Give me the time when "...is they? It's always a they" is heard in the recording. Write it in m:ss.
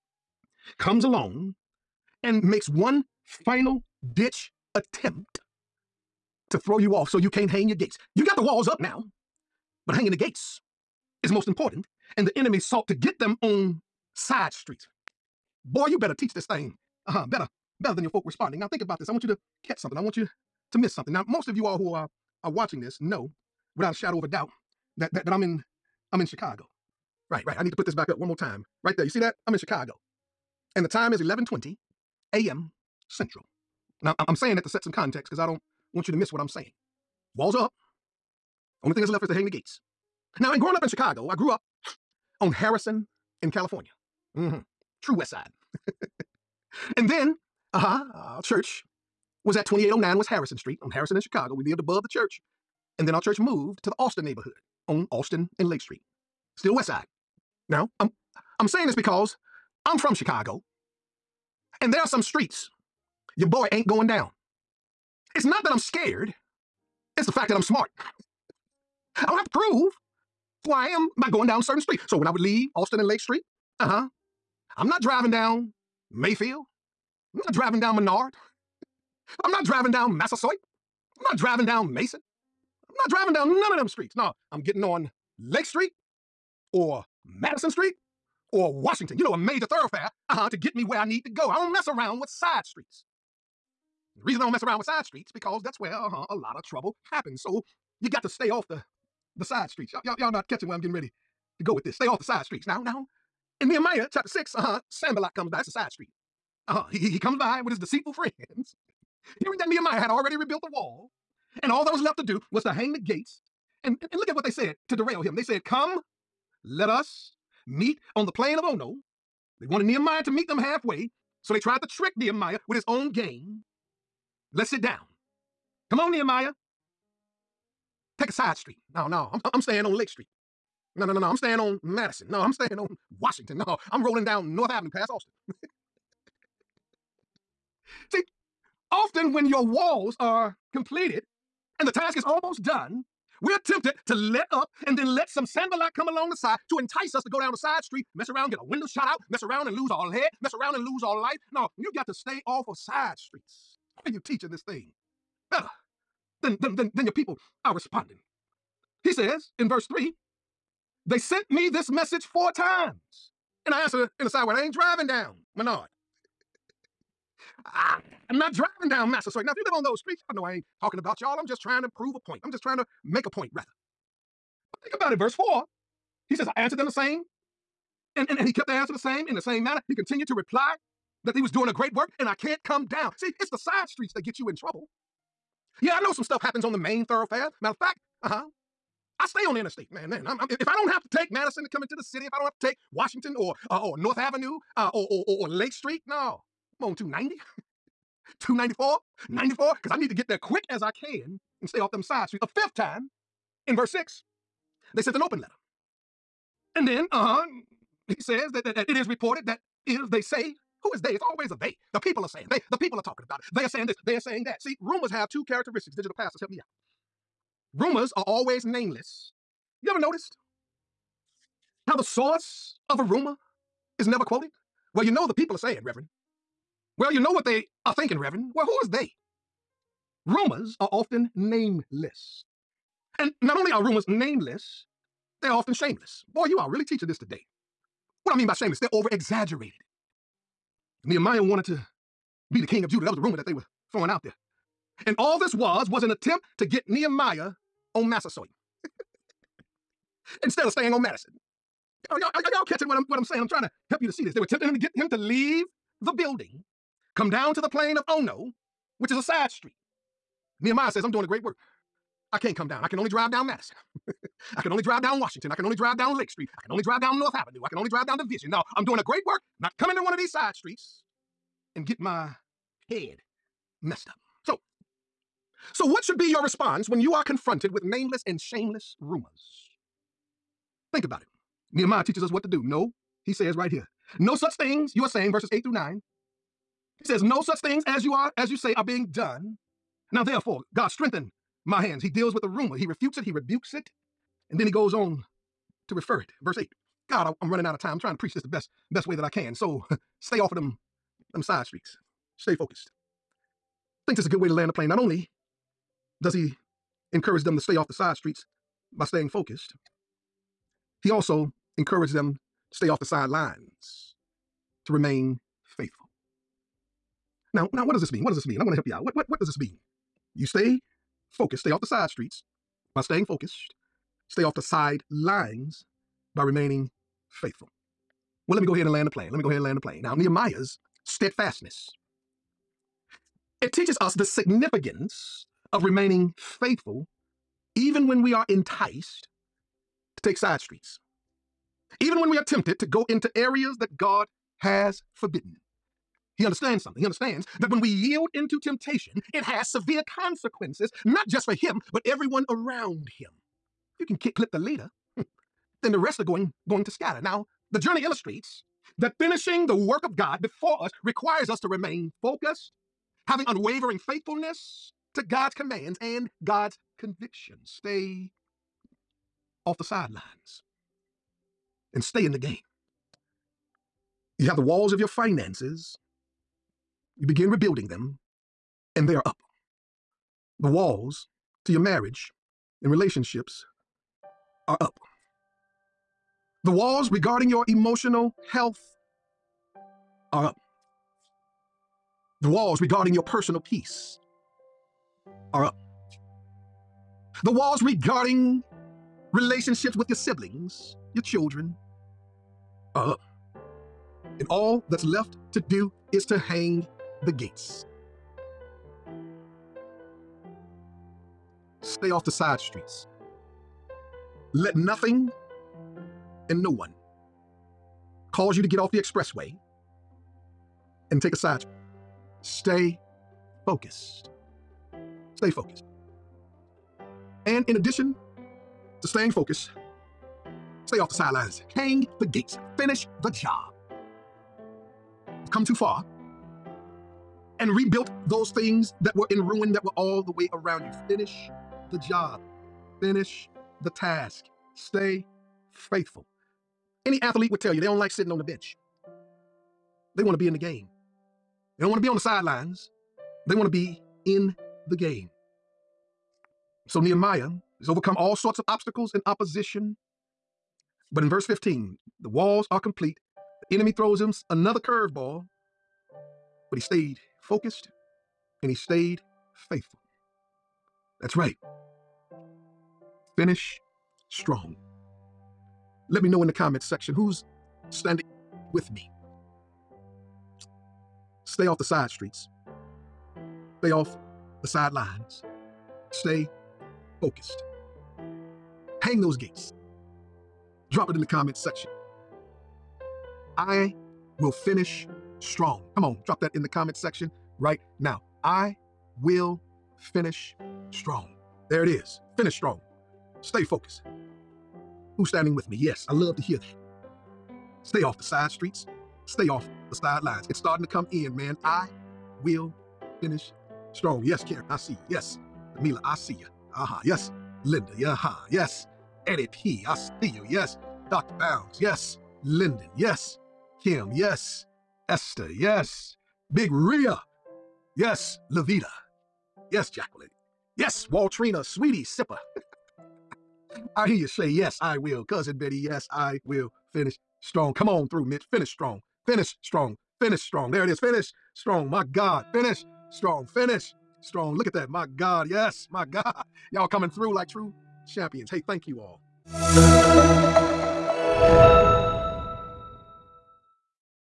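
3:30.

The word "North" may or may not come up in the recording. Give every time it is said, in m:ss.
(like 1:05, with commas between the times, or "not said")
2:14, 3:13, 4:27.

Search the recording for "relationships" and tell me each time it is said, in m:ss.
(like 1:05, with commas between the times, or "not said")
6:22, 6:39.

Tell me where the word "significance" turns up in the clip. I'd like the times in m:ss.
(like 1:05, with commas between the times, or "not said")
5:34.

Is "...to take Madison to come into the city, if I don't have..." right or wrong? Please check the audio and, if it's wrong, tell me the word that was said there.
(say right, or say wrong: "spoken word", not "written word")
right.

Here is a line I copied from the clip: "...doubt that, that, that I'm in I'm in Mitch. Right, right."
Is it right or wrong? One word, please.
wrong.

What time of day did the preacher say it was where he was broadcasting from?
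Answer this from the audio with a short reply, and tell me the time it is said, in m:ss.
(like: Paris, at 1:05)
11:20 a.m., at 0:31.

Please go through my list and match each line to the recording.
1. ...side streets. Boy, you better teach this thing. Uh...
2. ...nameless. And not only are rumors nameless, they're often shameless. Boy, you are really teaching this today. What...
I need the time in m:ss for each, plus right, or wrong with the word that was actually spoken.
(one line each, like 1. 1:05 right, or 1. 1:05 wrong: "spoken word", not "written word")
1. 0:14 right
2. 3:51 right.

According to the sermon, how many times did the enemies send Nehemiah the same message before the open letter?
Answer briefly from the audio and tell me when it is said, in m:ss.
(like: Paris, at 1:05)
4, at 2:42.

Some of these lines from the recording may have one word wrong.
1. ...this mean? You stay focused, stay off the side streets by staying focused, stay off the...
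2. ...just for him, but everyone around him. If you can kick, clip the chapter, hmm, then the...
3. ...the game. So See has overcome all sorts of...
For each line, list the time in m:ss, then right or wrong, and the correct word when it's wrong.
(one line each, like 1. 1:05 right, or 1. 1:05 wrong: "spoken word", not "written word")
1. 5:19 right
2. 5:51 wrong: "leader", not "chapter"
3. 7:34 wrong: "Nehemiah", not "See".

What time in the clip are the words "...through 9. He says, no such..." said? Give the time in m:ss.
4:45.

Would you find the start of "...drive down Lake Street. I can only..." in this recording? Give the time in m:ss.
4:25.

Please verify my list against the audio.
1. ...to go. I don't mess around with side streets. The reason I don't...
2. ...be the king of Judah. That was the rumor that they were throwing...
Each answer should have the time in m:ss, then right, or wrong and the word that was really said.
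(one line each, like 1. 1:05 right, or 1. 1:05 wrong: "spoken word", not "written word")
1. 1:31 right
2. 4:02 right.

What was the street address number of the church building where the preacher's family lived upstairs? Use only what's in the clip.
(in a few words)
2809.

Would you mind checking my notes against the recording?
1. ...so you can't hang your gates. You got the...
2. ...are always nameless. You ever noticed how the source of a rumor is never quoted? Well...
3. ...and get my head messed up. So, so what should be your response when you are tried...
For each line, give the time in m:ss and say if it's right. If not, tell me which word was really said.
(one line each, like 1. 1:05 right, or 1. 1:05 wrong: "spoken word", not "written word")
1. 0:07 right
2. 3:38 right
3. 4:31 wrong: "confronted", not "tried".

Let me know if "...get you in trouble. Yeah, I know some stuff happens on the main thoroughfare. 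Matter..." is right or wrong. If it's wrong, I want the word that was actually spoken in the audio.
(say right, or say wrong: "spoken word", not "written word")
right.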